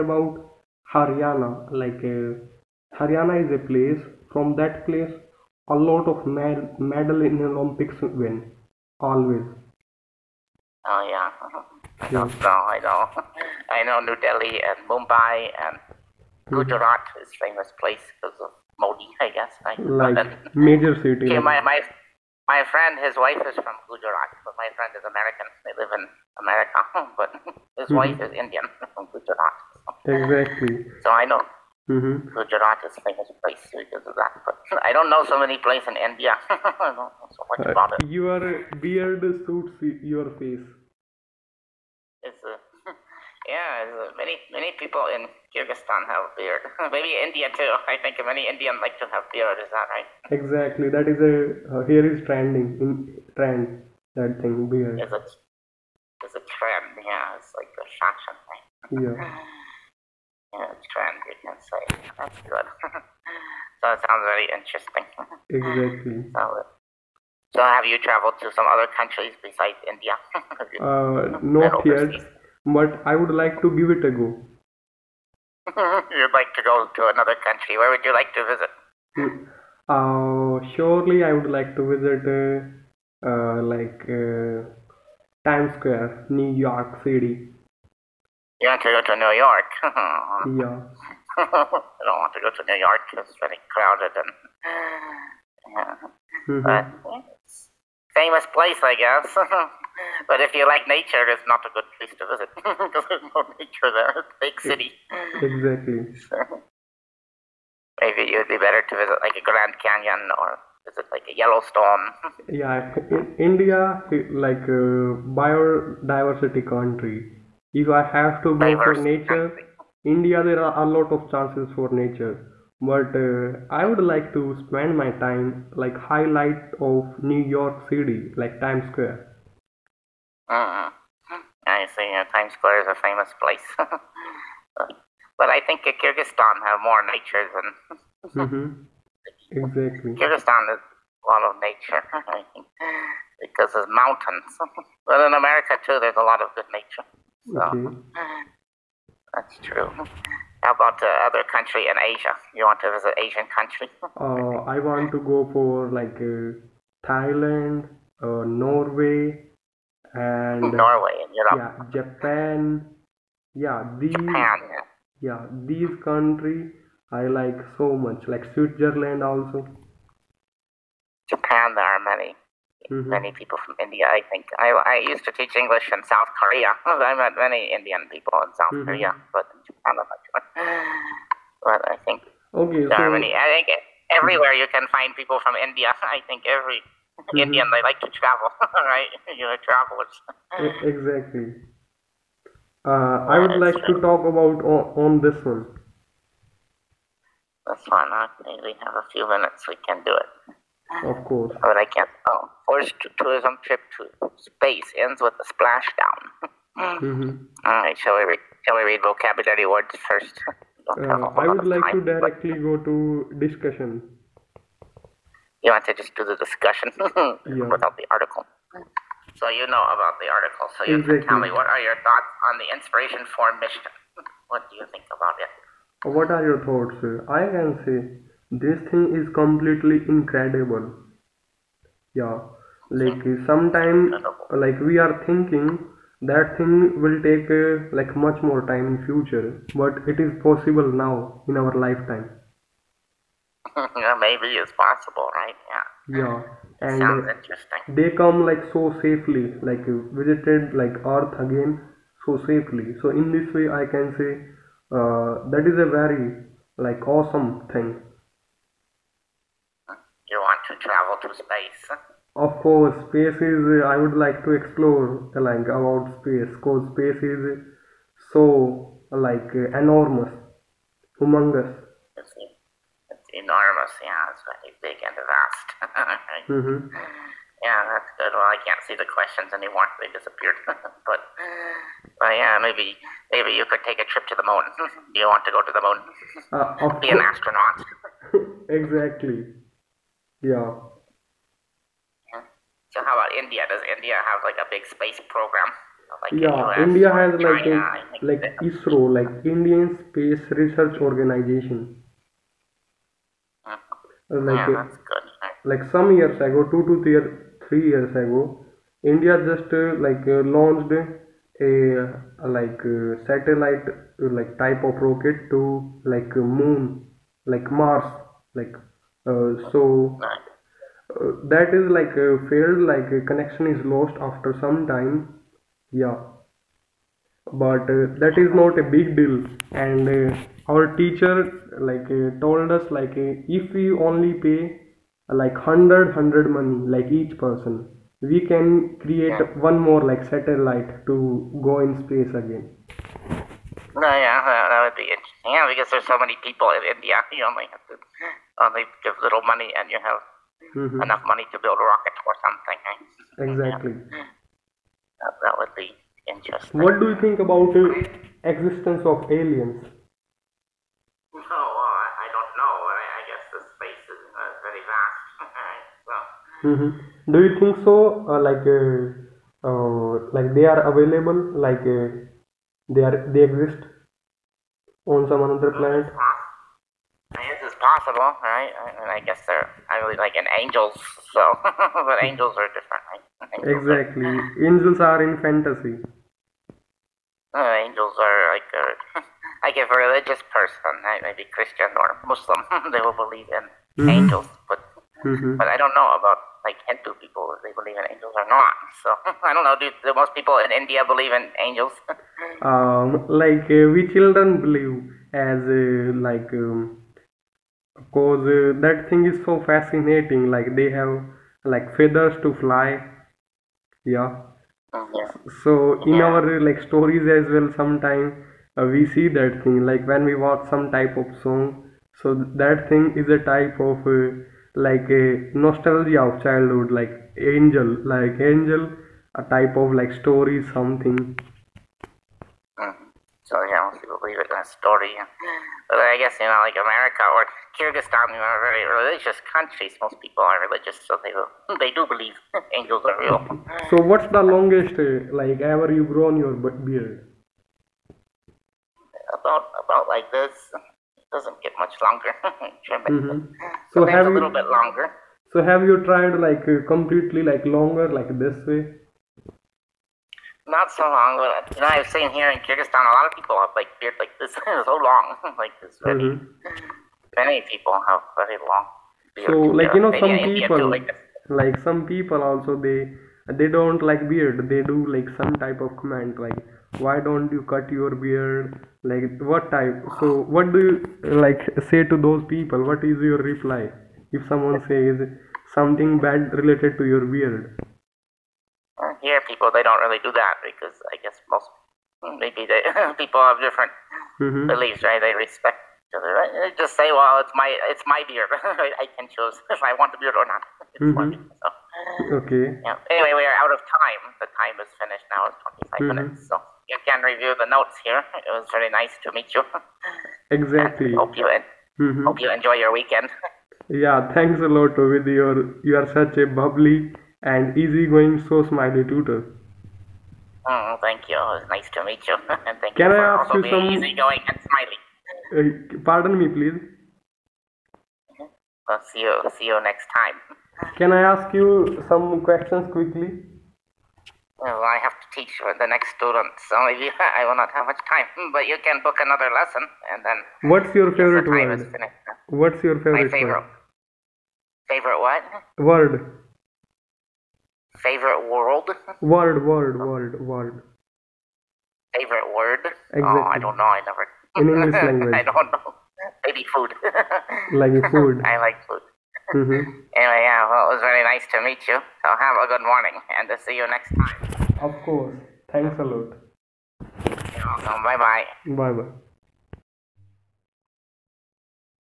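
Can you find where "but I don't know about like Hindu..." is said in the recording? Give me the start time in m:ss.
6:35.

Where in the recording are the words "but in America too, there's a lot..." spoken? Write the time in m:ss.
2:25.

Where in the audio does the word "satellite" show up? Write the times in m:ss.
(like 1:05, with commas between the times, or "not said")
5:13, 5:40.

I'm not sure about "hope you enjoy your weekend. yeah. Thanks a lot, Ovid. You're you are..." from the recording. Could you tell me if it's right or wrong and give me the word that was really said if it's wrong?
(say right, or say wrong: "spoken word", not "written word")
right.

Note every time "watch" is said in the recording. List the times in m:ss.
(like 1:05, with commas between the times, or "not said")
7:00.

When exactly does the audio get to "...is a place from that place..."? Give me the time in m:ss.
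0:03.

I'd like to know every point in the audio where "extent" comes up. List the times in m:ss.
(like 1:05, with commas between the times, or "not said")
not said.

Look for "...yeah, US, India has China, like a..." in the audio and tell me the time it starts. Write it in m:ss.
4:56.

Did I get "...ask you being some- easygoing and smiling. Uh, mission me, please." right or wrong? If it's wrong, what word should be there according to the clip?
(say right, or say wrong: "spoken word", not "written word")
wrong: "pardon", not "mission".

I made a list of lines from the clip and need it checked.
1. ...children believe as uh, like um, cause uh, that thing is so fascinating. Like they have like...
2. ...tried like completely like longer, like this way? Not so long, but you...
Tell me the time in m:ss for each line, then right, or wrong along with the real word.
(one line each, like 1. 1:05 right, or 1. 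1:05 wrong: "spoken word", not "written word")
1. 6:44 right
2. 7:36 right.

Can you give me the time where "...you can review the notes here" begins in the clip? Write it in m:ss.
8:26.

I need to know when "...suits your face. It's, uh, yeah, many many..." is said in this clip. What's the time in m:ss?
0:39.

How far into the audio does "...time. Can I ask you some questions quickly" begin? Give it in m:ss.
8:50.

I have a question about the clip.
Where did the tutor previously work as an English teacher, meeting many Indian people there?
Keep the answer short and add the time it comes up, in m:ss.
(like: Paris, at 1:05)
South Korea, at 2:56.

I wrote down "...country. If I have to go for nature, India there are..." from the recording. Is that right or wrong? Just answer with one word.
right.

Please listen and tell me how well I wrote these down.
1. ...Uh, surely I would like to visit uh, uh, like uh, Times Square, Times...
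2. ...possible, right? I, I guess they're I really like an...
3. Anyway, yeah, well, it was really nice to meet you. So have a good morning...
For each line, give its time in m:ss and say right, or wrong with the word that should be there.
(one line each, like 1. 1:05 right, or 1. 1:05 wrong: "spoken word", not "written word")
1. 1:19 wrong: "New", not "Times"
2. 6:17 right
3. 9:20 right.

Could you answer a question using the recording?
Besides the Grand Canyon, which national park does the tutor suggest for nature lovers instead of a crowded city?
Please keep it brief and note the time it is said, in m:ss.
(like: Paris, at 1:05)
Yellowstone, at 1:51.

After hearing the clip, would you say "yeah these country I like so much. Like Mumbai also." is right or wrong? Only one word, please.
wrong.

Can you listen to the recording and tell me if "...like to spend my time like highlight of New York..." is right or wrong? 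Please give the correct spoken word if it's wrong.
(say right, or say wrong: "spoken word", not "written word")
right.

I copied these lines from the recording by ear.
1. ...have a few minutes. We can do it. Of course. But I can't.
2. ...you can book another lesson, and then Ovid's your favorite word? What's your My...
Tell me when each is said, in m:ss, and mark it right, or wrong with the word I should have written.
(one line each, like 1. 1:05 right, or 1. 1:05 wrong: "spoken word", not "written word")
1. 3:18 right
2. 8:58 wrong: "What", not "Ovid".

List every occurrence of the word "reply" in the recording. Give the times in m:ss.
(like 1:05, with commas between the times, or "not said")
8:03.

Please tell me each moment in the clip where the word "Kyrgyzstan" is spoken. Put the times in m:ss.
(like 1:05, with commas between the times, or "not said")
0:45, 2:15, 2:20, 7:17, 7:42.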